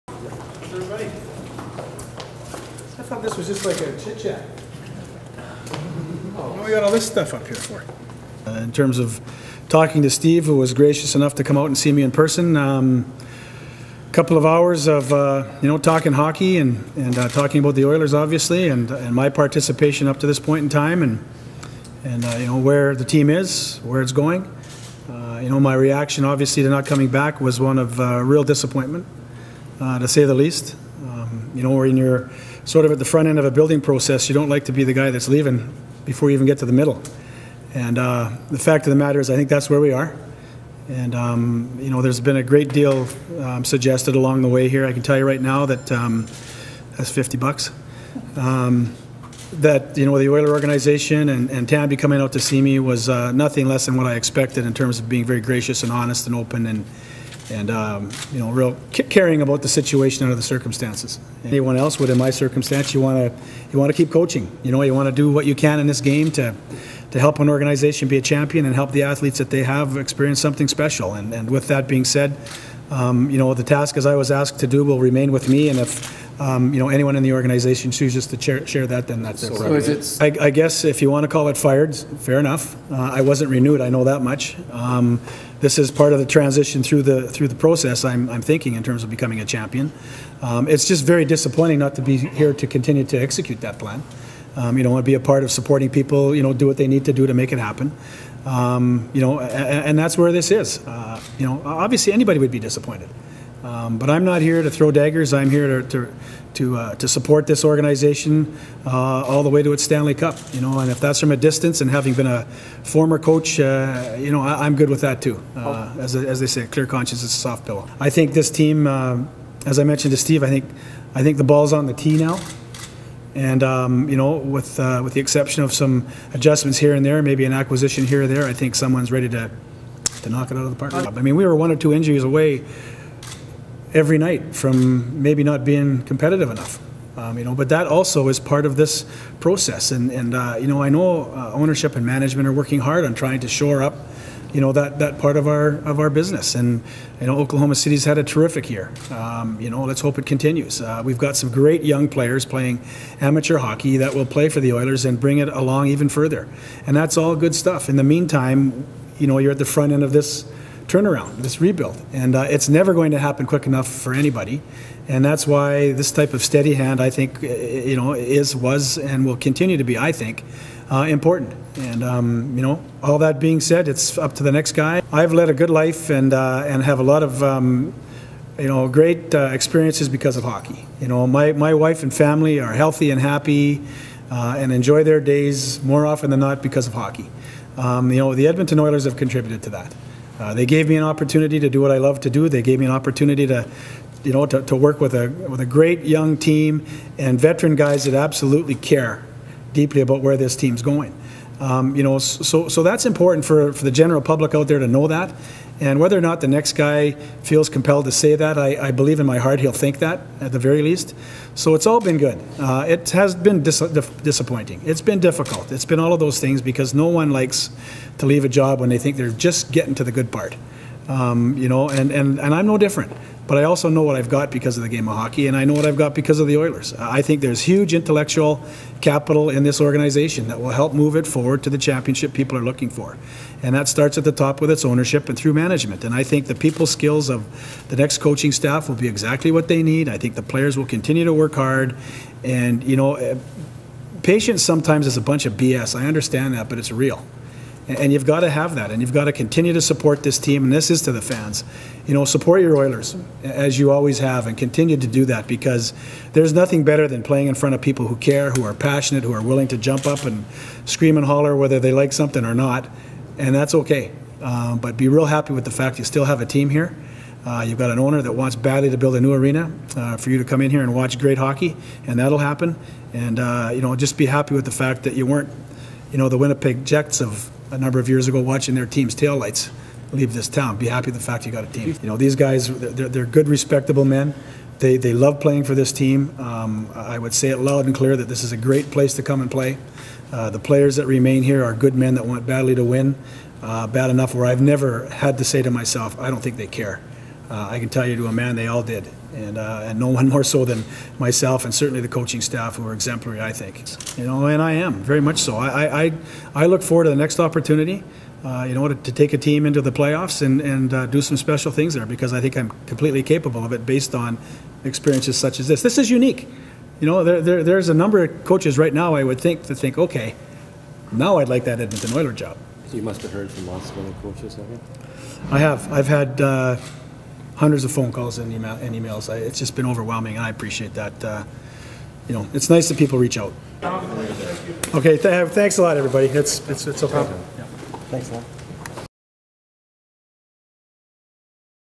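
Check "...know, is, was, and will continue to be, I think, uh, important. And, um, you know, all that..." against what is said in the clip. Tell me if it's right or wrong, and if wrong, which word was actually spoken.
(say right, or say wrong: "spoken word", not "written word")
right.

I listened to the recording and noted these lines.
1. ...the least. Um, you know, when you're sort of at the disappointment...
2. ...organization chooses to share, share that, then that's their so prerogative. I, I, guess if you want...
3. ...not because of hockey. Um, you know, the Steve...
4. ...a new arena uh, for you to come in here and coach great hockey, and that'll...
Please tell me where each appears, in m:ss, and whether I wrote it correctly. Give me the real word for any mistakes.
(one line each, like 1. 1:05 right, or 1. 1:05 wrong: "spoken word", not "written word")
1. 0:30 wrong: "front", not "disappointment"
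2. 1:17 right
3. 3:06 wrong: "Edmonton", not "Steve"
4. 4:29 wrong: "watch", not "coach".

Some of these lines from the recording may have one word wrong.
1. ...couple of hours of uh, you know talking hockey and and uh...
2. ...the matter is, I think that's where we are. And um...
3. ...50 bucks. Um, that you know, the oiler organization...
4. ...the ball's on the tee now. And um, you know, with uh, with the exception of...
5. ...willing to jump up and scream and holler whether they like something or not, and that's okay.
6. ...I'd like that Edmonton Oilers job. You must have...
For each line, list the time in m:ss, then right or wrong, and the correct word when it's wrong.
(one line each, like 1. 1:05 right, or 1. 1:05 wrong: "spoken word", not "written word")
1. 0:14 right
2. 0:38 right
3. 0:47 right
4. 2:01 right
5. 4:19 right
6. 5:21 right.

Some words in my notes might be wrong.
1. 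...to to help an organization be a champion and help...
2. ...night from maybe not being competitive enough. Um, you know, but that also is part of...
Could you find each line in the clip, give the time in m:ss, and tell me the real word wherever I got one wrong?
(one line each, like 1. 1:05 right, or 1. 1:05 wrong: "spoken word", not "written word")
1. 1:06 right
2. 2:14 right.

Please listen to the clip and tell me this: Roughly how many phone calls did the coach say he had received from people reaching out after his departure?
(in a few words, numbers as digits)
hundreds.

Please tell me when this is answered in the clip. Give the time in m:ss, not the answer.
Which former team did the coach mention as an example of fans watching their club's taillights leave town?
4:36.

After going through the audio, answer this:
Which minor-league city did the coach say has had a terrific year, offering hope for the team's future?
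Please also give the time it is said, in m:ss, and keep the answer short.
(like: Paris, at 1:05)
Oklahoma City, at 2:27.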